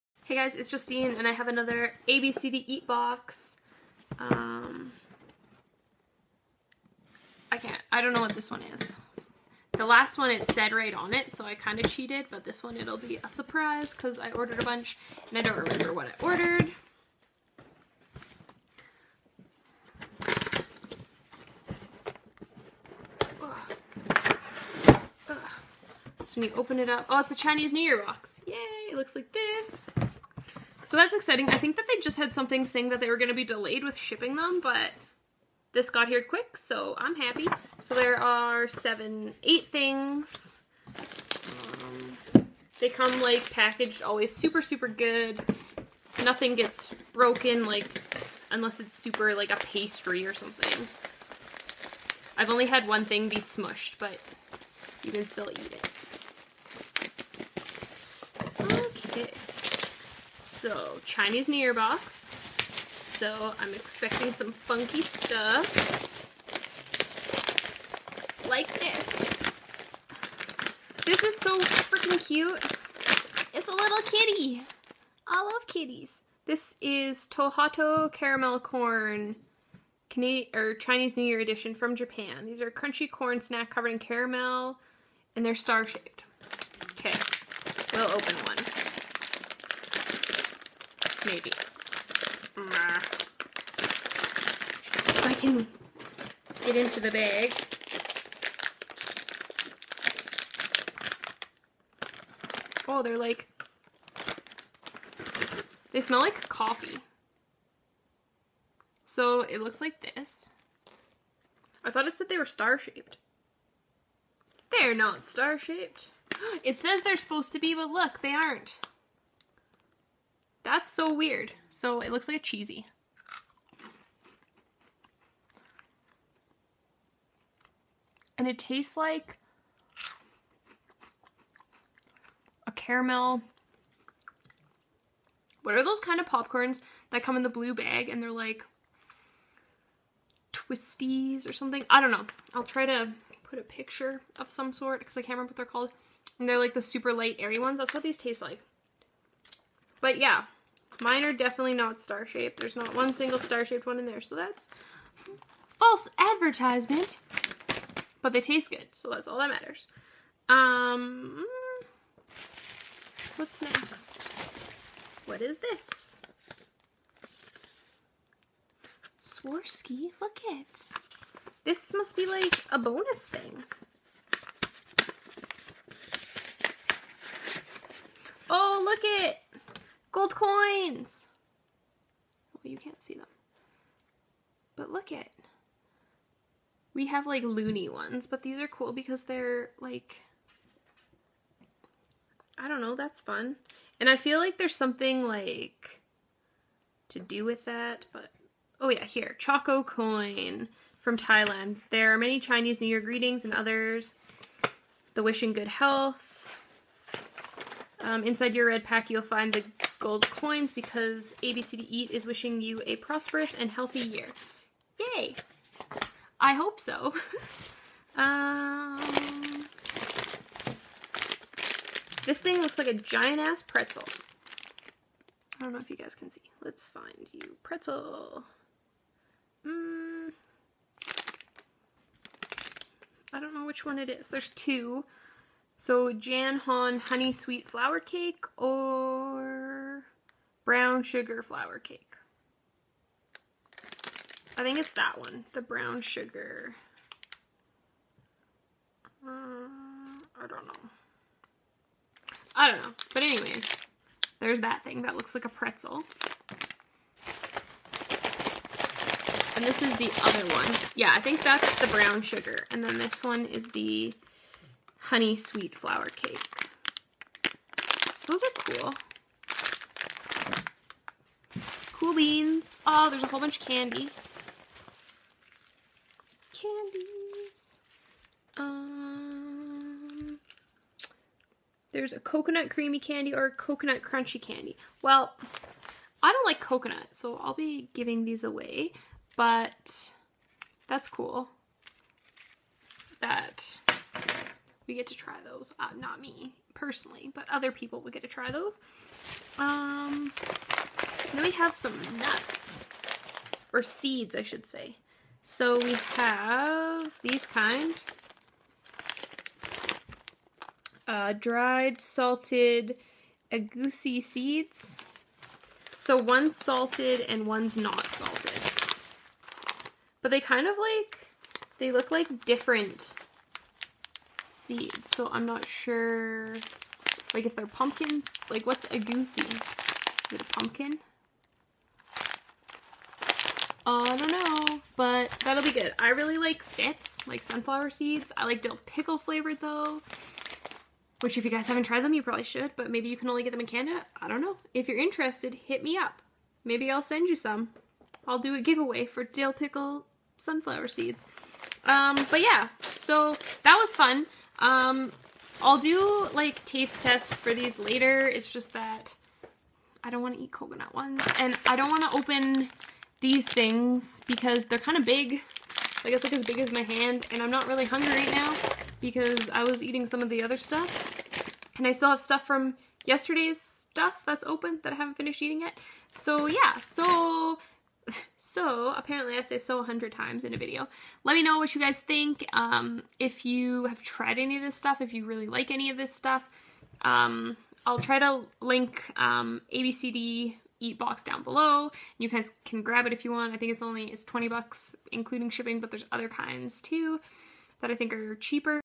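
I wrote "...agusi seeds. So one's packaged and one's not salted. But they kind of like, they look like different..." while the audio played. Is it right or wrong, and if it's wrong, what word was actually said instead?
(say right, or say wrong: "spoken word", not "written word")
wrong: "salted", not "packaged".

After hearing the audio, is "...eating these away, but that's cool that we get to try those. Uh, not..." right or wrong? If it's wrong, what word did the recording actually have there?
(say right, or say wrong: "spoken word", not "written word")
wrong: "giving", not "eating".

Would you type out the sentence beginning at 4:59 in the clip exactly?
Um, then we have some nuts, or seeds, I should say.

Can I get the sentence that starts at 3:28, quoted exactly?
Um, inside your red pack, you'll find the gold coins because ABCDEat is wishing you a prosperous and healthy year.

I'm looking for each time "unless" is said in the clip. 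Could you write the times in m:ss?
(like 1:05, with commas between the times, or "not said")
0:48.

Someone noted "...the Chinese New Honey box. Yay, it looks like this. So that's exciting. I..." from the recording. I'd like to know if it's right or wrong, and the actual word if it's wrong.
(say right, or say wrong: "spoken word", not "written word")
wrong: "Year", not "Honey".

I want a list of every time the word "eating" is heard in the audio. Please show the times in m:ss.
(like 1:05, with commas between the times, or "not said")
6:09, 6:15.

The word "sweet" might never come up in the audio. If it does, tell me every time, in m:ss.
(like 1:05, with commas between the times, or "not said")
3:57, 4:25.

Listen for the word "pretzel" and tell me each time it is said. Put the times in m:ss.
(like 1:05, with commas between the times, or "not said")
3:43, 3:47, 4:15.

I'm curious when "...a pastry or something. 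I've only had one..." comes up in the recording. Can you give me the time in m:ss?
0:49.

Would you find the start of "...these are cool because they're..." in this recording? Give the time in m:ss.
3:08.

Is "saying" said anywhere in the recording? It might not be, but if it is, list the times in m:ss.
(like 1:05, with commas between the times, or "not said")
0:32.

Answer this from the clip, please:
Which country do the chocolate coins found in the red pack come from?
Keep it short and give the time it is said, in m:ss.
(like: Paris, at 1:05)
Thailand, at 3:21.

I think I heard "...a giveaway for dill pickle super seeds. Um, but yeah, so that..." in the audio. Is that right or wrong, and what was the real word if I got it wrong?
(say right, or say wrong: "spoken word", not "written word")
wrong: "sunflower", not "super".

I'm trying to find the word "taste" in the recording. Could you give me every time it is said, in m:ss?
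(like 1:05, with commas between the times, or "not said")
2:08, 2:28, 2:38, 5:56.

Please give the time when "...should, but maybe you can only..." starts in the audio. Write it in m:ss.
5:42.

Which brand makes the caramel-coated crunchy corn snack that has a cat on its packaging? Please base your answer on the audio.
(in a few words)
Tohato.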